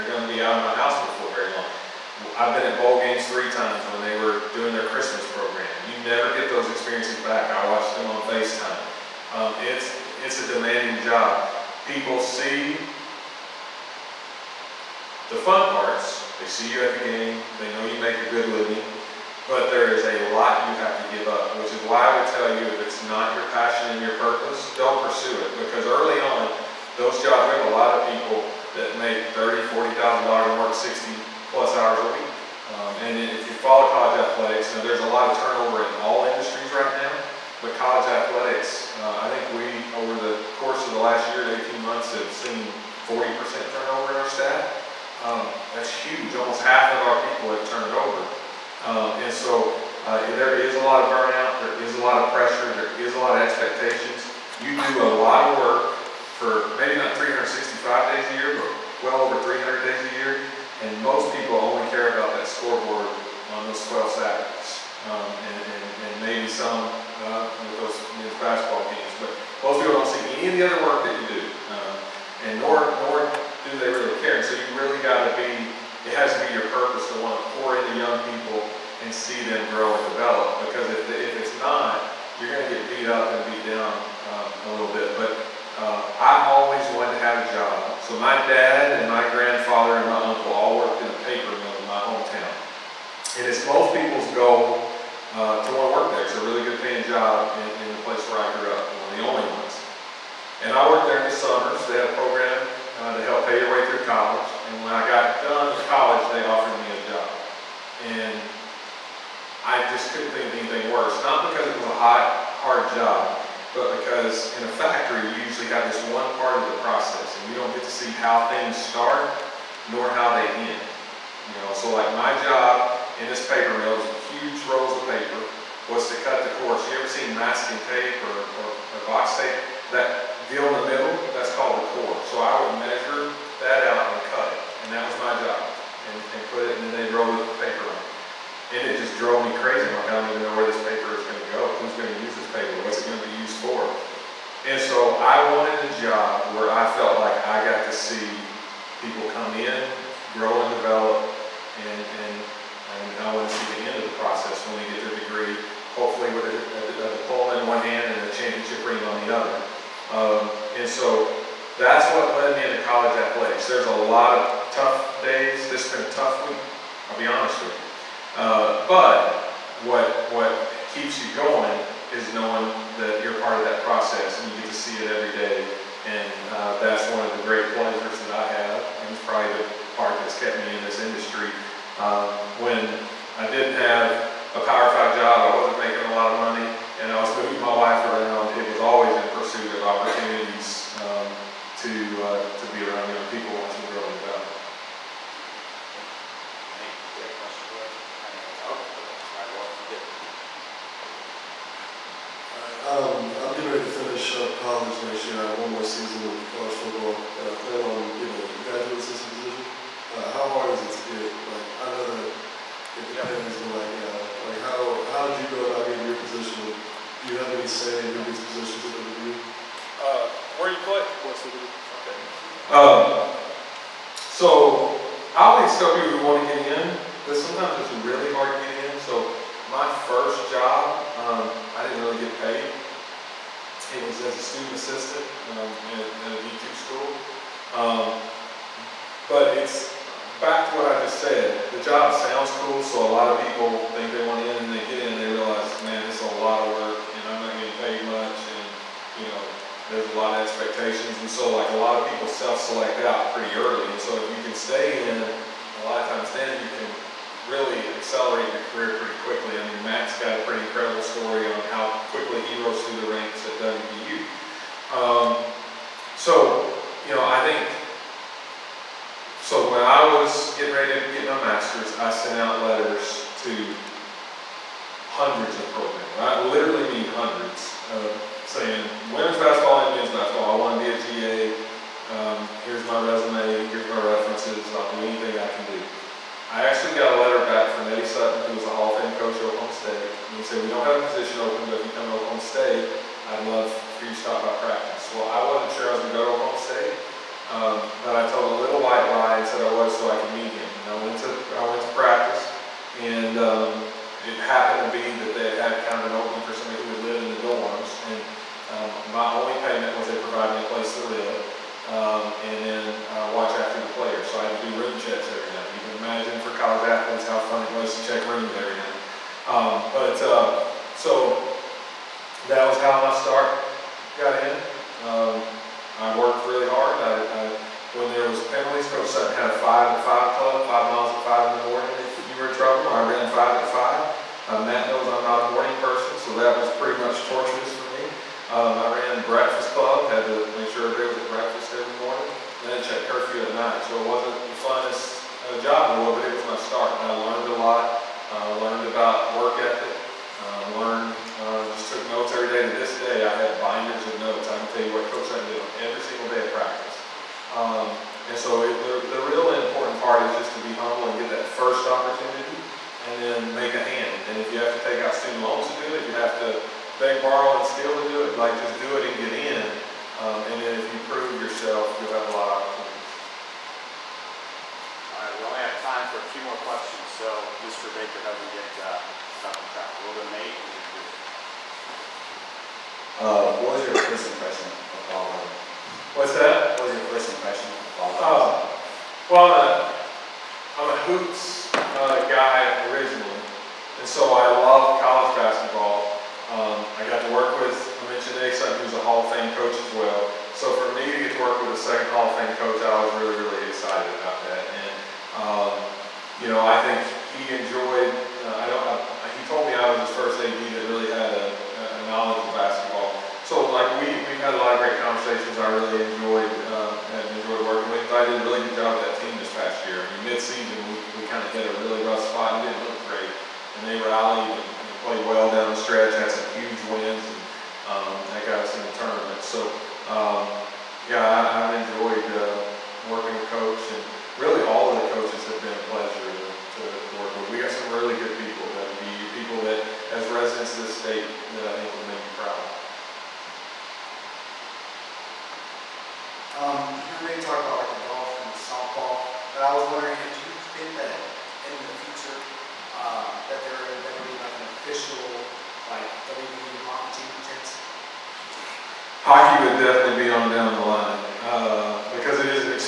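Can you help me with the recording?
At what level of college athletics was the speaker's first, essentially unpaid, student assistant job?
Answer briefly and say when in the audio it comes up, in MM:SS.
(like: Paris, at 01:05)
D2, at 03:56.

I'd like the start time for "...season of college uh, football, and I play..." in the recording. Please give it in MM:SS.
03:25.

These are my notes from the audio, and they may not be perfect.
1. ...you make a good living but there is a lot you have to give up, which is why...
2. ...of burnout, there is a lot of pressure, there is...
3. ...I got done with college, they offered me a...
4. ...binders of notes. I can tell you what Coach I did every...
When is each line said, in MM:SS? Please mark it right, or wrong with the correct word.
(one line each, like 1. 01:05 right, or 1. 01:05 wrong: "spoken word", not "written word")
1. 00:17 right
2. 00:51 right
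3. 01:44 right
4. 05:53 right.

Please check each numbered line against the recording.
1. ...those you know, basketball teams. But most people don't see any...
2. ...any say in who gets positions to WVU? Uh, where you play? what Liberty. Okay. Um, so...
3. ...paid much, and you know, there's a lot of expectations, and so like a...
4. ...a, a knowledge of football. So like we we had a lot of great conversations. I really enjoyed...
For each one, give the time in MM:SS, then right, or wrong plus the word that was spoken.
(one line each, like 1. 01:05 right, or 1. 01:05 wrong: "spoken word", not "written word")
1. 01:07 right
2. 03:37 right
3. 04:07 right
4. 06:51 wrong: "basketball", not "football".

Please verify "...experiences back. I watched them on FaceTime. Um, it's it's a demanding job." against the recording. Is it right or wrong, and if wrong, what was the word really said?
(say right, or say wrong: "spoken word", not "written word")
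right.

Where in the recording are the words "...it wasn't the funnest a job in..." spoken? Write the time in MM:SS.
05:44.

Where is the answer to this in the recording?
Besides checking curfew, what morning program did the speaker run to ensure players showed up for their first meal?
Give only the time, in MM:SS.
05:39.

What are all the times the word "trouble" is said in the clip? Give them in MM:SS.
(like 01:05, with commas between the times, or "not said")
05:32.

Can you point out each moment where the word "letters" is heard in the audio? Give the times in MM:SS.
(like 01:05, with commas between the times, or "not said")
04:32, 04:47.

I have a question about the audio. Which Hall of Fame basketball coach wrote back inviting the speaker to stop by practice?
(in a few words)
Eddie Sutton.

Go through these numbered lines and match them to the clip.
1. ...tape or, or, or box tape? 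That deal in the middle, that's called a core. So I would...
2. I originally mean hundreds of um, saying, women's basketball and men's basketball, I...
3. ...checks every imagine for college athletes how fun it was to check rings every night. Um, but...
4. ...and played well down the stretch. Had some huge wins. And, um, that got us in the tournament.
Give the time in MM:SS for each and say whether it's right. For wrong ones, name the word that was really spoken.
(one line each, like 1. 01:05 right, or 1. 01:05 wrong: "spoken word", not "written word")
1. 02:07 right
2. 04:36 wrong: "literally", not "originally"
3. 05:14 right
4. 07:04 right.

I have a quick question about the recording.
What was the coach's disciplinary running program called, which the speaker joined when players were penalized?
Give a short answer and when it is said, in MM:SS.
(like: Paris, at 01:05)
Five at five club, at 05:29.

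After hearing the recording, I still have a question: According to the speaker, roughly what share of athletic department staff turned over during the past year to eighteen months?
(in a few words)
40%.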